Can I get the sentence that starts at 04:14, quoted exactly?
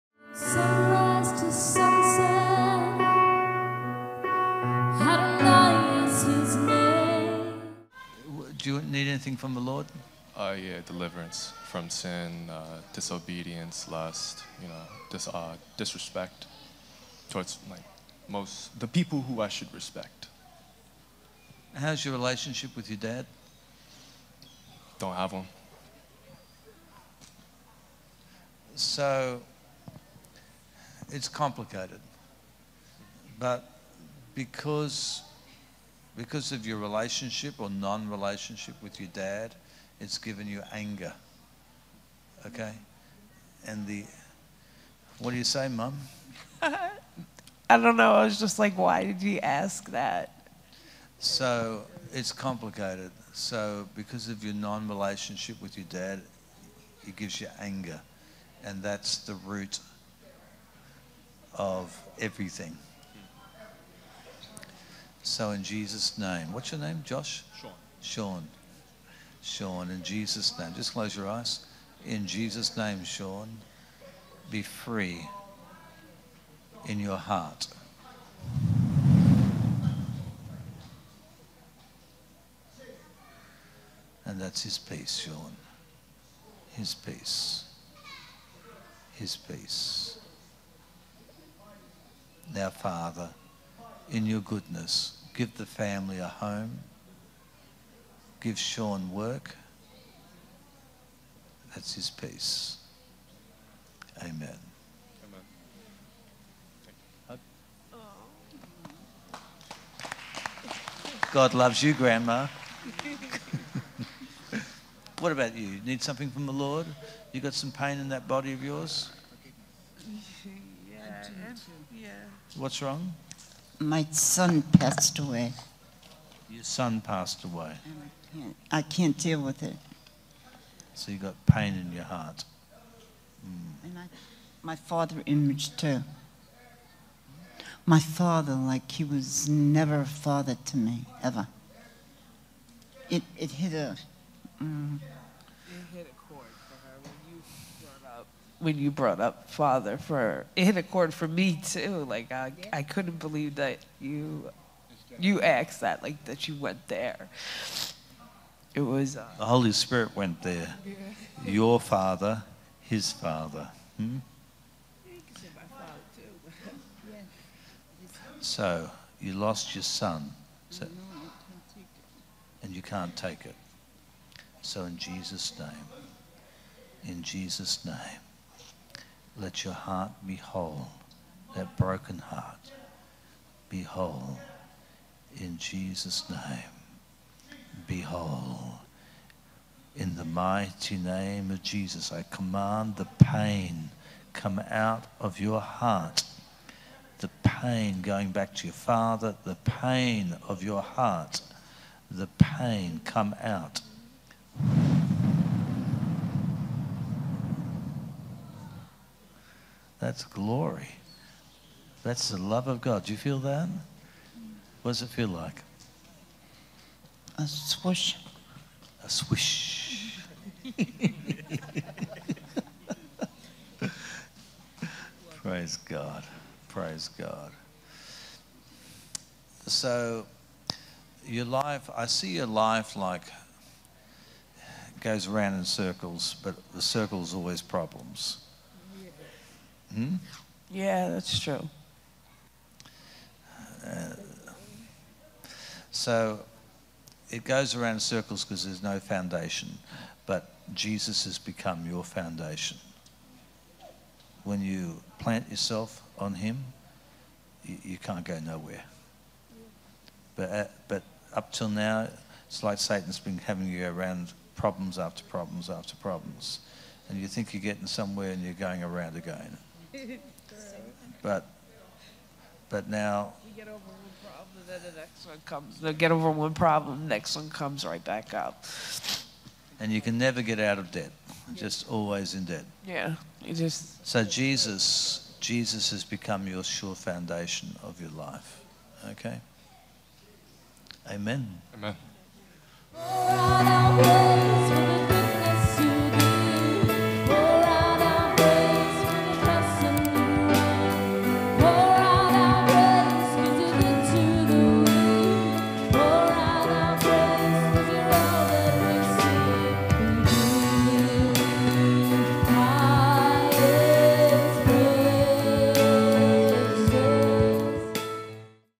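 When you plant yourself on Him, you, you can't go nowhere.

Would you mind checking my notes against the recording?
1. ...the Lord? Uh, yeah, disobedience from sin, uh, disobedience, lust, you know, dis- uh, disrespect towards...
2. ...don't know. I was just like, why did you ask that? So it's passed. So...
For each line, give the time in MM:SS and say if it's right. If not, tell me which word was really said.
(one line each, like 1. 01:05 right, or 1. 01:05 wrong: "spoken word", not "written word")
1. 00:09 wrong: "deliverance", not "disobedience"
2. 00:47 wrong: "complicated", not "passed".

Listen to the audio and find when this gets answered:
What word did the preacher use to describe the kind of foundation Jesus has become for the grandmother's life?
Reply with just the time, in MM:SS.
04:46.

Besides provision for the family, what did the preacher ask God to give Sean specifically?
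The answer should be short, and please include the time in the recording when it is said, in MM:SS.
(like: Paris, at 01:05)
Work, at 01:39.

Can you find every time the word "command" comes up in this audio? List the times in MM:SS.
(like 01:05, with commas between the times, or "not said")
03:12.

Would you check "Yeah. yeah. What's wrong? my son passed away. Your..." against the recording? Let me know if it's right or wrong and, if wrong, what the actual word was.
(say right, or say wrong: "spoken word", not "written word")
right.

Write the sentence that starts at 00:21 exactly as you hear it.
How's your relationship with your dad?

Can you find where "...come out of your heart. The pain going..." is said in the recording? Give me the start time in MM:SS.
03:14.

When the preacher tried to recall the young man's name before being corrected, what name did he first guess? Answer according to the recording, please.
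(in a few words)
Josh.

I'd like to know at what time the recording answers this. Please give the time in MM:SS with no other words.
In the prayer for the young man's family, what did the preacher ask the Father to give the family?
01:36.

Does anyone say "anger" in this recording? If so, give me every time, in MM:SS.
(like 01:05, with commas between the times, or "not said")
00:40, 00:57.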